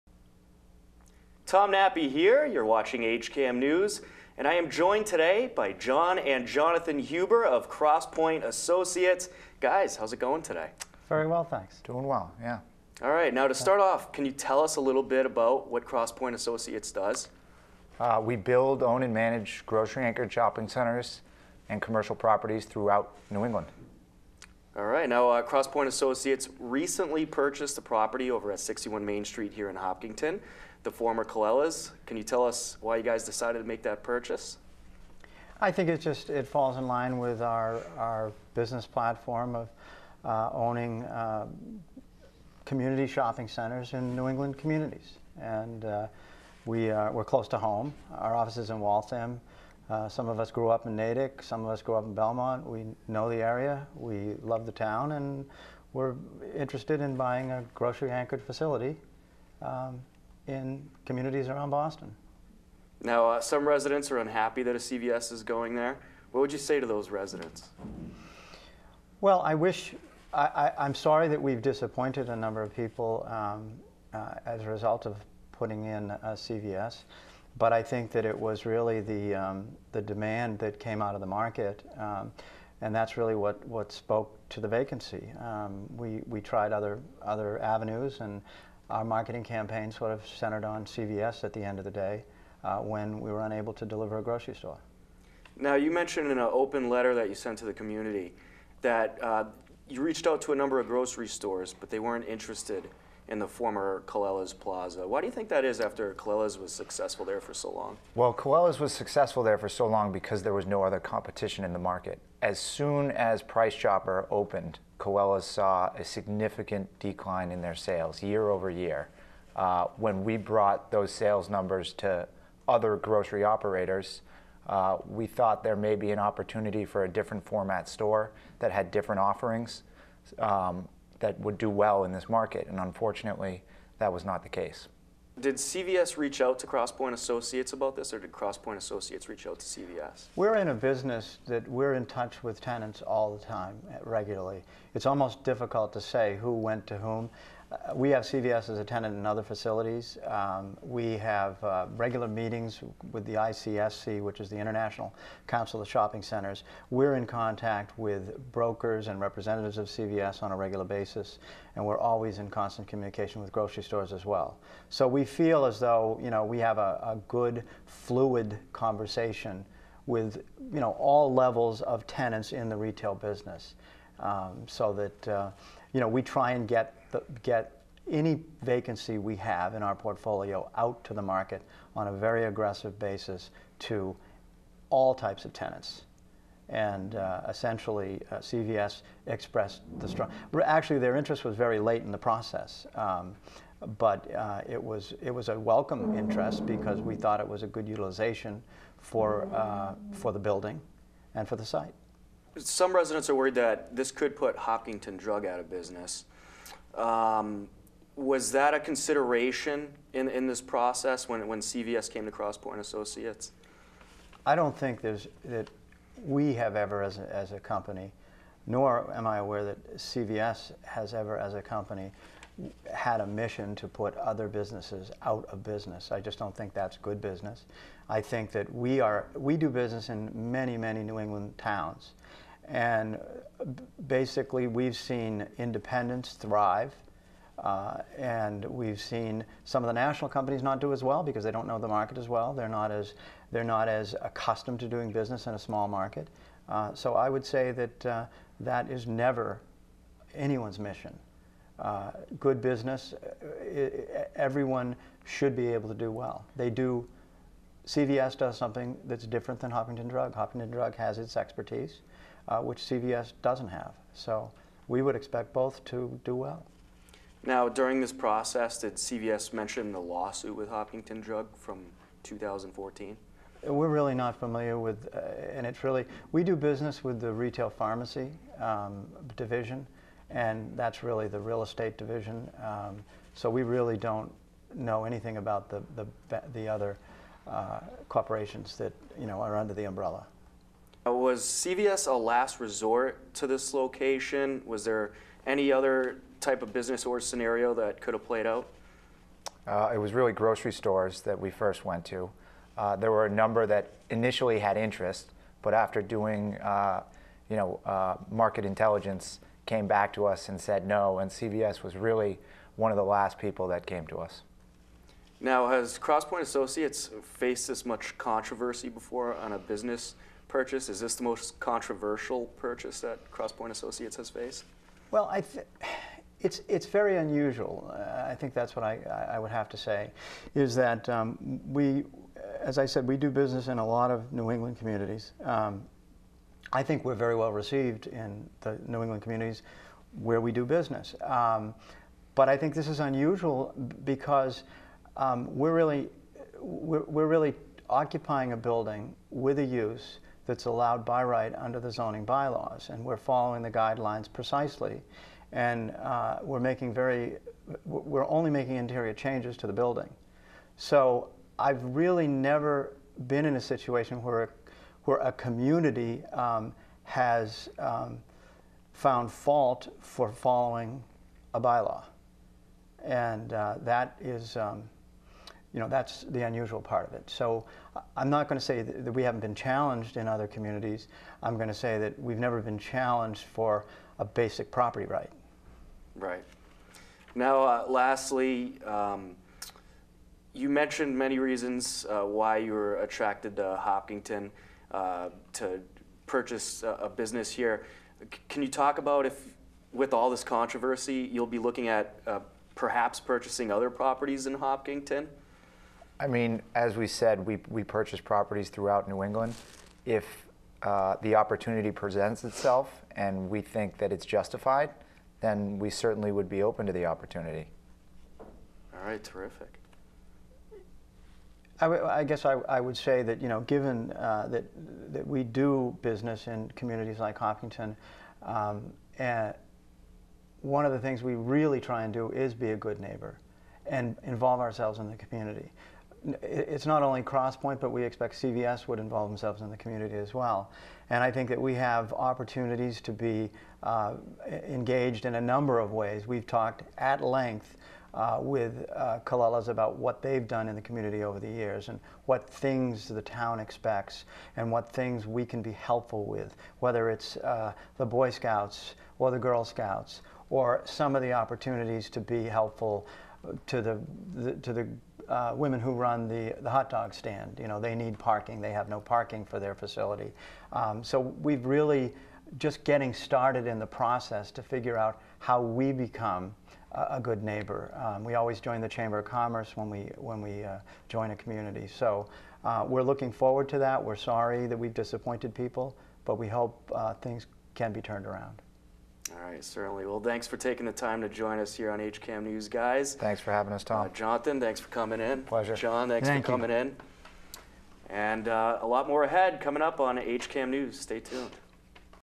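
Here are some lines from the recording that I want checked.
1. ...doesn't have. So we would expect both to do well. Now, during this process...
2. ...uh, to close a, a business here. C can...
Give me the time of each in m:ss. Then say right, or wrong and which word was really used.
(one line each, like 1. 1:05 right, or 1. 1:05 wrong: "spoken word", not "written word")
1. 4:23 right
2. 6:34 wrong: "purchase", not "close".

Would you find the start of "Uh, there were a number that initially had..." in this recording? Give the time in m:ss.
5:02.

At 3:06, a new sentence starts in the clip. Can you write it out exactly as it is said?
And uh, essentially, uh, CVS expressed the strong.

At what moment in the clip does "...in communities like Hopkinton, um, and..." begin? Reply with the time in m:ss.
7:06.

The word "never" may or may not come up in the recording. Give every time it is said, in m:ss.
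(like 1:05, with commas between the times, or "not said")
4:09, 6:02, 6:22.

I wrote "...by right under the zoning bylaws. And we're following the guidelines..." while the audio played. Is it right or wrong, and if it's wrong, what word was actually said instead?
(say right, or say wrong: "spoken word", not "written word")
right.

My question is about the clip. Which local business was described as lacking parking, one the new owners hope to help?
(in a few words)
the hot dog stand.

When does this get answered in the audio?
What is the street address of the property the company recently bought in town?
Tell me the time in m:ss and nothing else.
0:28.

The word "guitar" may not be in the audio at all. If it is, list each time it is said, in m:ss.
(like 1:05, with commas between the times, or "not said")
not said.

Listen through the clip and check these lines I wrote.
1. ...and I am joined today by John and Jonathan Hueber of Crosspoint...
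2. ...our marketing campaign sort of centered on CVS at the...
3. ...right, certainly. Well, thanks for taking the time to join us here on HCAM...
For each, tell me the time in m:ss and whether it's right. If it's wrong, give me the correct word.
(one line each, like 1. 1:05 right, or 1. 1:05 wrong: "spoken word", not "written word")
1. 0:04 right
2. 1:28 right
3. 8:09 right.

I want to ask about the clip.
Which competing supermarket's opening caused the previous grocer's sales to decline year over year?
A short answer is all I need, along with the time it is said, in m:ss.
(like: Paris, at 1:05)
Price Chopper, at 1:53.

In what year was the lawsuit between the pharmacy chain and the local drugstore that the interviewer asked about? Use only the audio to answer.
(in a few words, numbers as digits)
2014.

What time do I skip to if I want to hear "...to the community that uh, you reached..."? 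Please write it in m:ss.
1:37.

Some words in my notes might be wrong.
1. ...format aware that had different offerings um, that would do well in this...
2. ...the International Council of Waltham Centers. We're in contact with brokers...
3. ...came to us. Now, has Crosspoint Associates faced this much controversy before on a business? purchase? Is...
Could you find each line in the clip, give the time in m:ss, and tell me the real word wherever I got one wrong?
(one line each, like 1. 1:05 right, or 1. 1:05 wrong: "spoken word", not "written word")
1. 2:07 wrong: "store", not "aware"
2. 2:34 wrong: "Shopping", not "Waltham"
3. 5:13 right.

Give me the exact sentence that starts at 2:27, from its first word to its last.
Uh, we have CVS as a tenant in other facilities.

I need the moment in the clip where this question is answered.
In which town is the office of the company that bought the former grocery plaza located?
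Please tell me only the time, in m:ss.
0:48.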